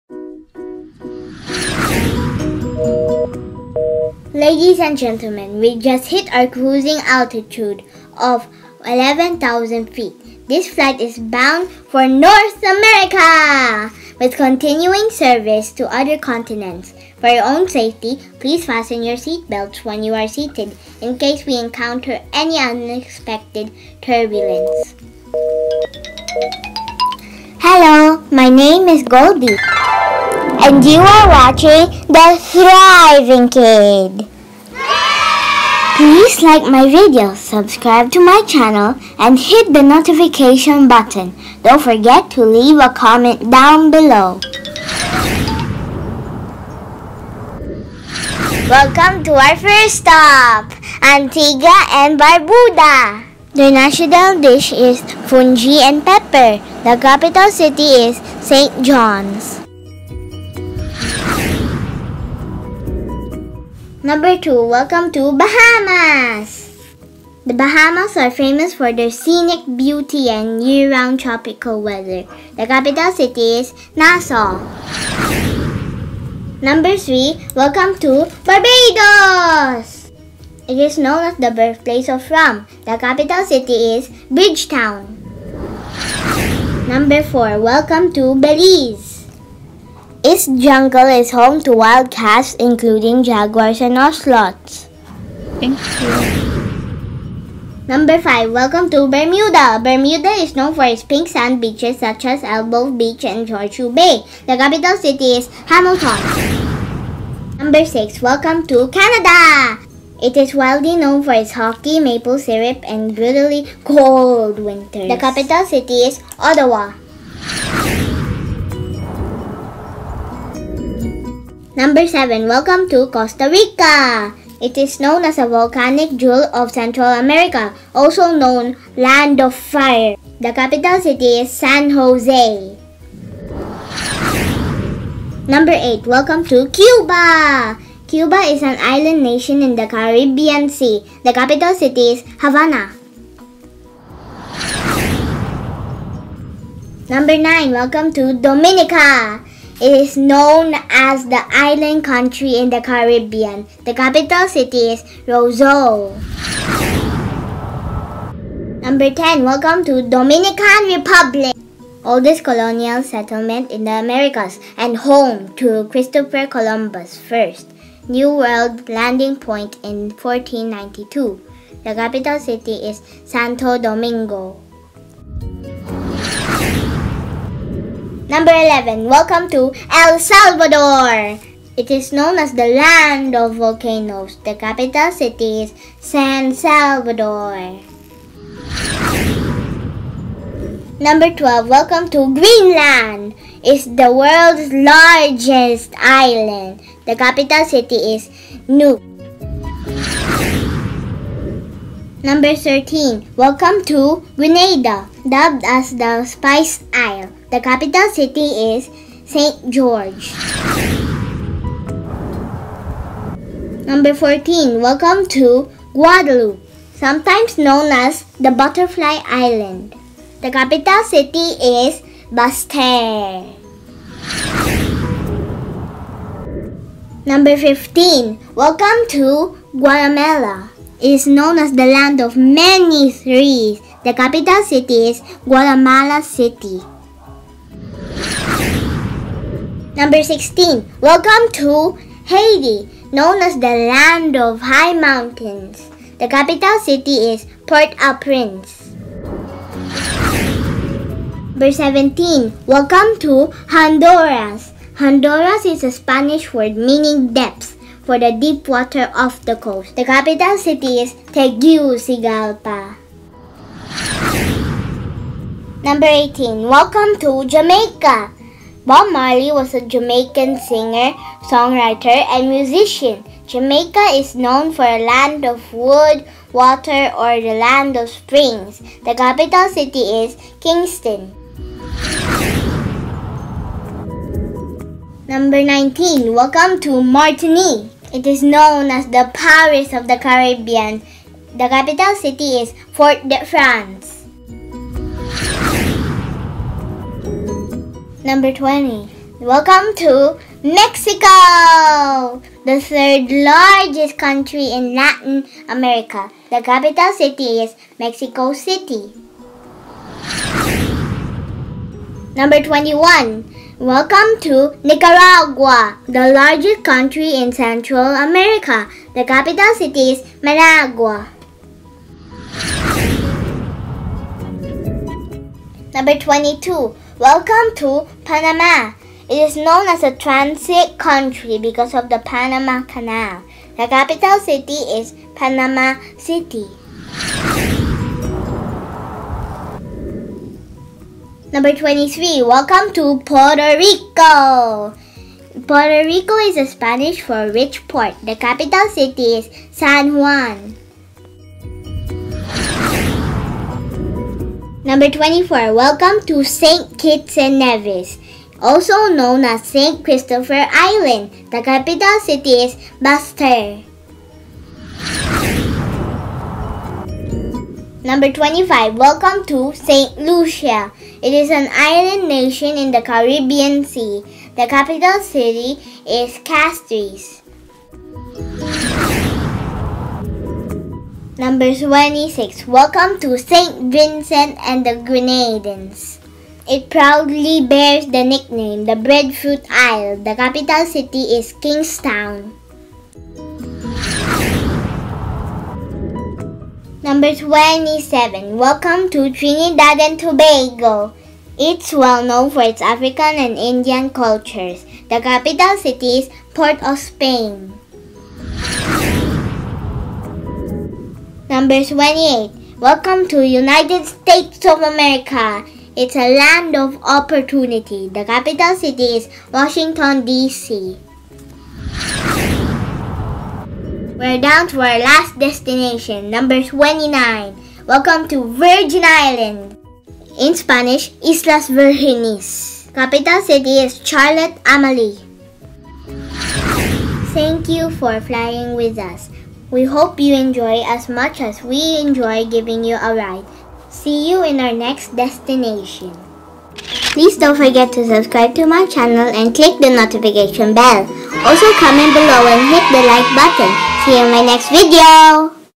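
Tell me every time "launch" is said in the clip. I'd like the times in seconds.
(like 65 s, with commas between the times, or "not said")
not said.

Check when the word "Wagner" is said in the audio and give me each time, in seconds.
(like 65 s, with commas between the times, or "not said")
not said.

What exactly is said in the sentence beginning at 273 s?
Jamaica is known for a land of wood, water, or the land of springs.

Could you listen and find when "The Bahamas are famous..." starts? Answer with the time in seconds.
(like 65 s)
67 s.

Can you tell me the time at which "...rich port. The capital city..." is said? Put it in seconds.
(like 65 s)
347 s.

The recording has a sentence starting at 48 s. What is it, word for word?
Welcome to our first stop, Antigua and Barbuda.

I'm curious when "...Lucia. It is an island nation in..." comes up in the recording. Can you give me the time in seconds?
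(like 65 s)
370 s.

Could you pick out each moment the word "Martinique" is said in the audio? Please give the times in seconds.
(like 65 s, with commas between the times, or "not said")
287 s.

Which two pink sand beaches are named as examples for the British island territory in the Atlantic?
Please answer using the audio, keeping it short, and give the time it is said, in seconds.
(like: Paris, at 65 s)
Elbow Beach and Horseshoe Bay, at 102 s.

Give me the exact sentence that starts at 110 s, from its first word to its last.
It is widely known for its hockey, maple syrup, and brutally cold winters.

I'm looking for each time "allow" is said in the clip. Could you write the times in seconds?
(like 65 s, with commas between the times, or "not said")
not said.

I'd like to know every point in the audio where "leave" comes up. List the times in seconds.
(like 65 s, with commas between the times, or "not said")
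42 s.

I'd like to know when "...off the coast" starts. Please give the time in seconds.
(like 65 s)
259 s.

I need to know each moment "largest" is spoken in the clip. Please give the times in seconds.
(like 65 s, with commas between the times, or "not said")
194 s, 303 s, 316 s.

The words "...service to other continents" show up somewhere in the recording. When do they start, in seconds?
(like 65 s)
15 s.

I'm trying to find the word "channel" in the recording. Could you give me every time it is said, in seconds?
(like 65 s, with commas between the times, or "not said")
38 s, 448 s.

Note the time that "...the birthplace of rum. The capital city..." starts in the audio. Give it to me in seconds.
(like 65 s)
81 s.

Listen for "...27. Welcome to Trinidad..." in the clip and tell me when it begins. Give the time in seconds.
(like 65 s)
397 s.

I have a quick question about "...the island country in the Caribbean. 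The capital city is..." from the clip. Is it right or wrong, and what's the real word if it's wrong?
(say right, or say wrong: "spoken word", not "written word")
right.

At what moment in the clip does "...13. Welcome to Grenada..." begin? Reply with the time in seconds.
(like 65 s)
202 s.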